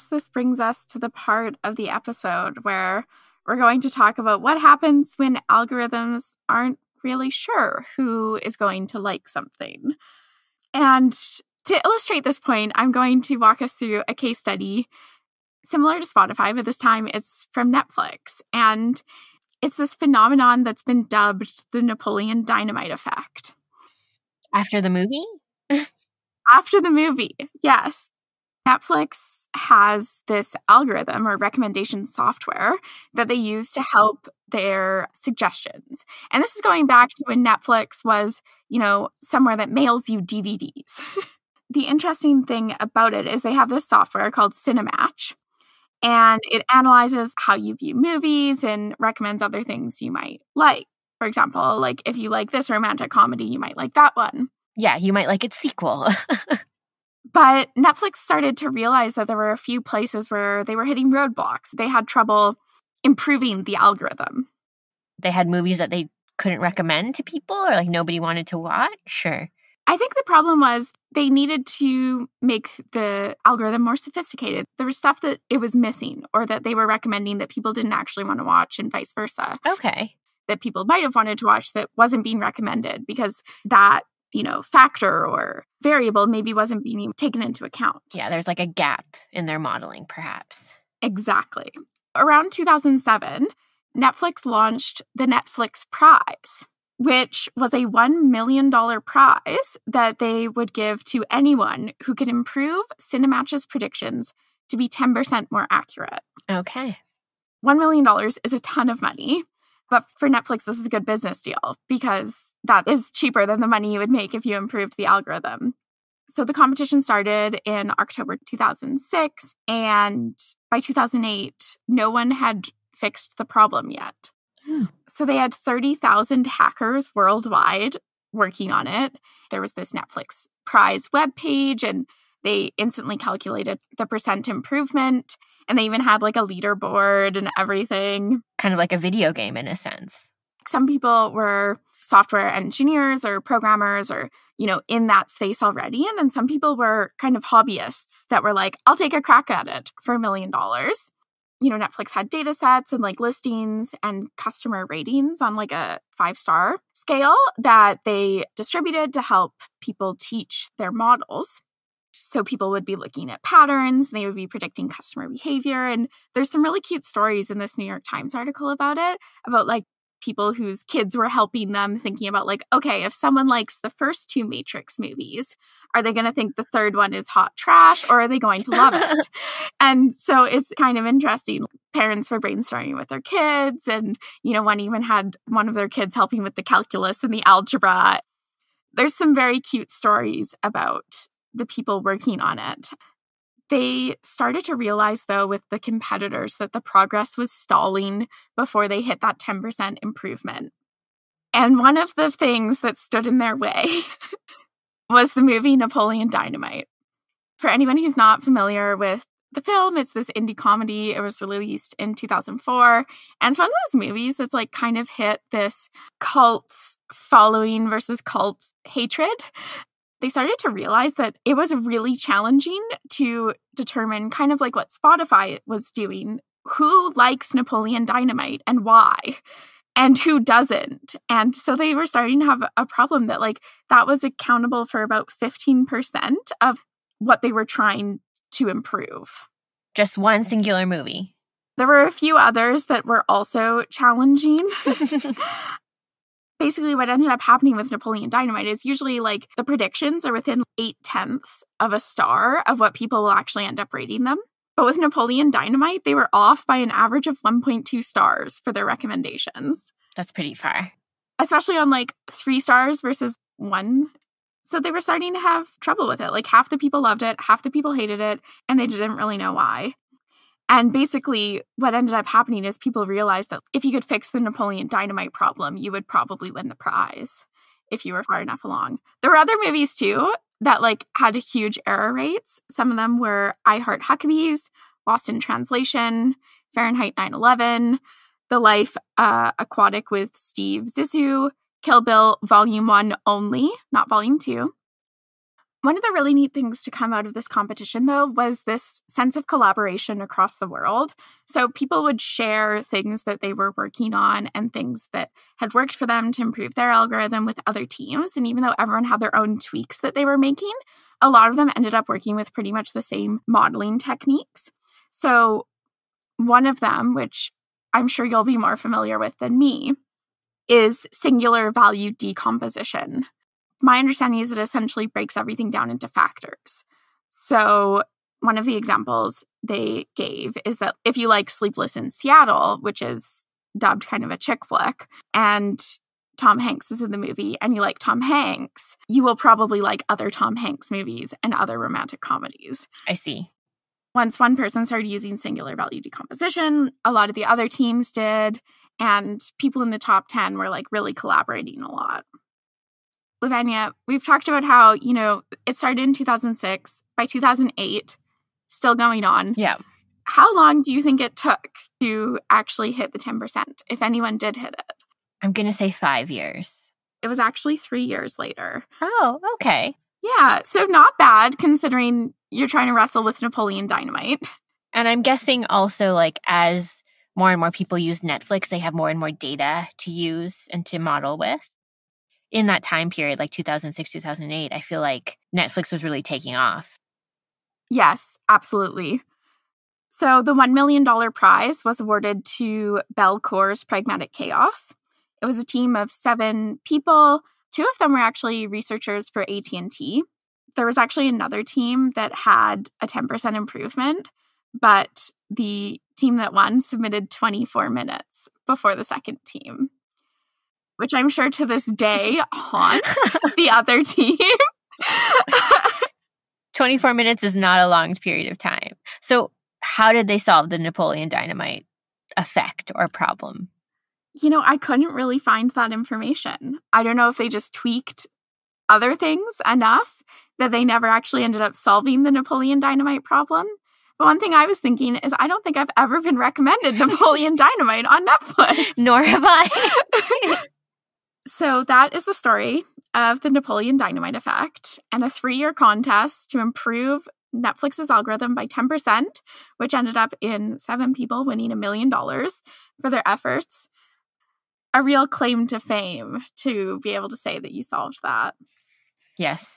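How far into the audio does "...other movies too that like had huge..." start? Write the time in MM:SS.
04:39.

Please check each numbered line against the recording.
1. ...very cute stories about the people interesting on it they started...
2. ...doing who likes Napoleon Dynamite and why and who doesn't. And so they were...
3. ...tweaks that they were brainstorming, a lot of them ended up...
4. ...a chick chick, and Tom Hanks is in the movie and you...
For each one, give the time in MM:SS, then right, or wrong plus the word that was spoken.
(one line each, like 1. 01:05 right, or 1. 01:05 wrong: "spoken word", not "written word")
1. 03:09 wrong: "working", not "interesting"
2. 03:45 right
3. 05:09 wrong: "making", not "brainstorming"
4. 05:34 wrong: "flick", not "chick".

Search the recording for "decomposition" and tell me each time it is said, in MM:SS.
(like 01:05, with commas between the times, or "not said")
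05:22, 05:46.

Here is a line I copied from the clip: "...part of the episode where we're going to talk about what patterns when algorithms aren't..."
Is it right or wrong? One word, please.
wrong.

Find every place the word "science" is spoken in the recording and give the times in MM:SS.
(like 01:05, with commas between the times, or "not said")
not said.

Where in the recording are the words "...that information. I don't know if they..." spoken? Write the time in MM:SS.
07:05.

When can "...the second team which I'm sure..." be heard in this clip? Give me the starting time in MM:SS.
06:48.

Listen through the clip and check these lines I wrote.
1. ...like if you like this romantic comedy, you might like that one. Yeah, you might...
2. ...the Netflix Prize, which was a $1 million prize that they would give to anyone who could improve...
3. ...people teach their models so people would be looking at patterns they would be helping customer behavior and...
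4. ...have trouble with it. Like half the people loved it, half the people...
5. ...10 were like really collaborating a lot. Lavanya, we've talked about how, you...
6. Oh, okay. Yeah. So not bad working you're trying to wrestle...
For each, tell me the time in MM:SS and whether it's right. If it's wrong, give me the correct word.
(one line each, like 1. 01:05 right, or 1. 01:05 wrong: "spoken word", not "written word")
1. 00:51 right
2. 01:35 right
3. 02:39 wrong: "predicting", not "helping"
4. 04:25 right
5. 05:50 right
6. 06:09 wrong: "considering", not "working".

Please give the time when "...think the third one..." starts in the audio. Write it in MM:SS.
02:56.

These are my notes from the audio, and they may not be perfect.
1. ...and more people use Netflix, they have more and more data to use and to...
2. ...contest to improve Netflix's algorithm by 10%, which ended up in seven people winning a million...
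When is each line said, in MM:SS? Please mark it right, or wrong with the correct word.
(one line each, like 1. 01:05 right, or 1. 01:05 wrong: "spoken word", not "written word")
1. 06:17 right
2. 07:25 right.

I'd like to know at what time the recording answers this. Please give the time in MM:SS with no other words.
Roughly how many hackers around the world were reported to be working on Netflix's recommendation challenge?
02:05.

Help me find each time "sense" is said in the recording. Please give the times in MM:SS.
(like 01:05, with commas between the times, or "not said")
02:19, 04:59.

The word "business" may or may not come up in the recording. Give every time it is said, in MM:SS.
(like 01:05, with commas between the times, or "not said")
01:51.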